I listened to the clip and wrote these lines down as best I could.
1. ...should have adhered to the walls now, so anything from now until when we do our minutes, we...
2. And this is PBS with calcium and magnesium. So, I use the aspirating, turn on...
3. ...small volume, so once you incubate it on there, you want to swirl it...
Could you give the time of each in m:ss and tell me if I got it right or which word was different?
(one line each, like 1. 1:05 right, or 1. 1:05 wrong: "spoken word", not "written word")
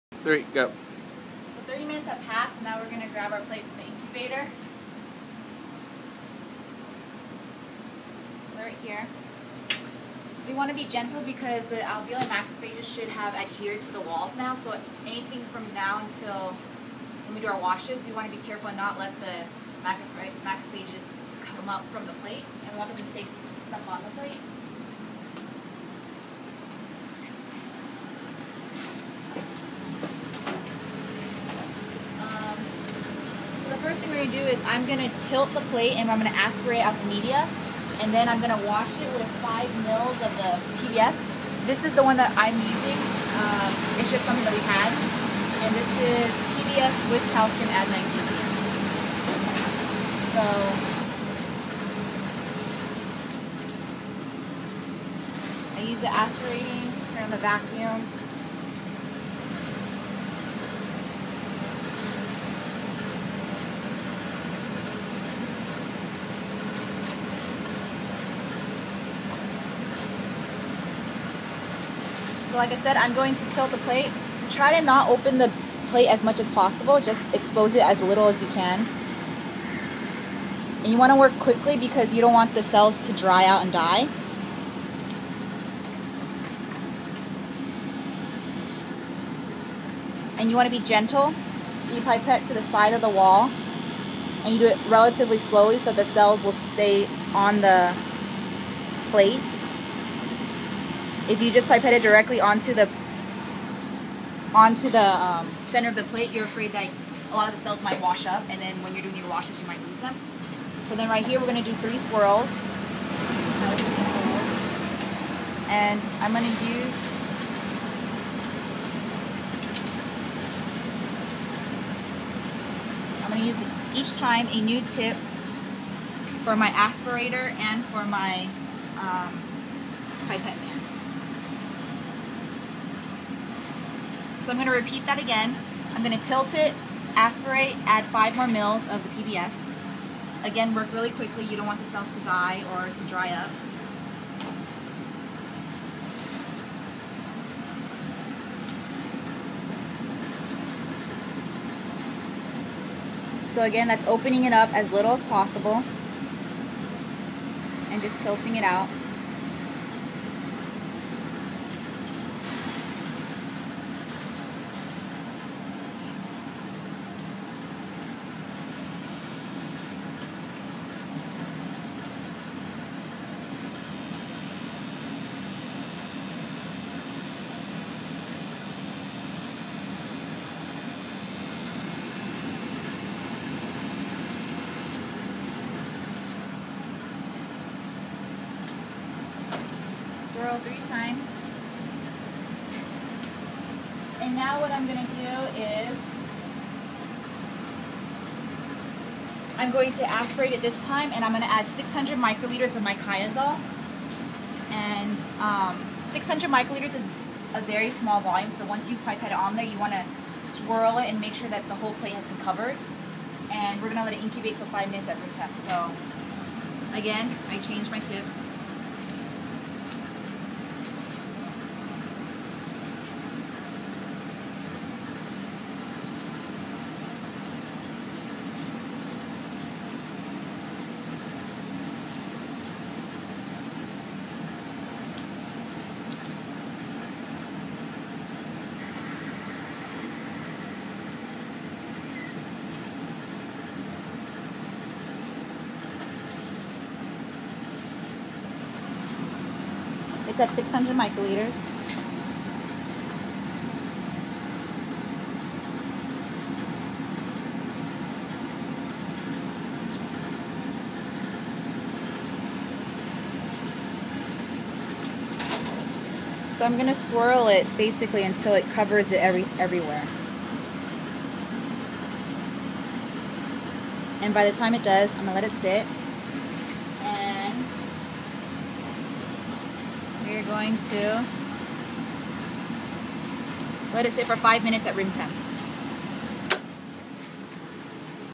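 1. 0:12 wrong: "washes", not "minutes"
2. 0:45 right
3. 3:27 wrong: "pipette", not "incubate".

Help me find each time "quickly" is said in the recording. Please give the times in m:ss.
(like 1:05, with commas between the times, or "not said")
1:21, 2:21.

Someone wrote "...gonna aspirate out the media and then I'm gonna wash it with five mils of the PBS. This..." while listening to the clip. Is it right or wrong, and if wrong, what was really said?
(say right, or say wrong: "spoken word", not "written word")
right.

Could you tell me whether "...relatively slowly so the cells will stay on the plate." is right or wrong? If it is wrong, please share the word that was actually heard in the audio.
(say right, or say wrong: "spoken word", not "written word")
right.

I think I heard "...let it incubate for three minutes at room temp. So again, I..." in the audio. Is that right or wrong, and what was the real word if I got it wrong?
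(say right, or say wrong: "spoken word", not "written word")
wrong: "five", not "three".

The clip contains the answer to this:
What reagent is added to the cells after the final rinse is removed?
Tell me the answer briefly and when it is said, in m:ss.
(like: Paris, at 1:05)
QIAzol, at 3:22.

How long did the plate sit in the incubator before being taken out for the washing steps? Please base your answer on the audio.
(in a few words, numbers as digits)
30 minutes.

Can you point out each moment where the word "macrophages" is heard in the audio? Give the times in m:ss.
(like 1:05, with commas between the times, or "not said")
0:12, 0:19.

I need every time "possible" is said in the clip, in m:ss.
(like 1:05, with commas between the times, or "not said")
1:16, 2:35.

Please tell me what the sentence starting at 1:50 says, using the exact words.
So then right here, we're gonna do three swirls.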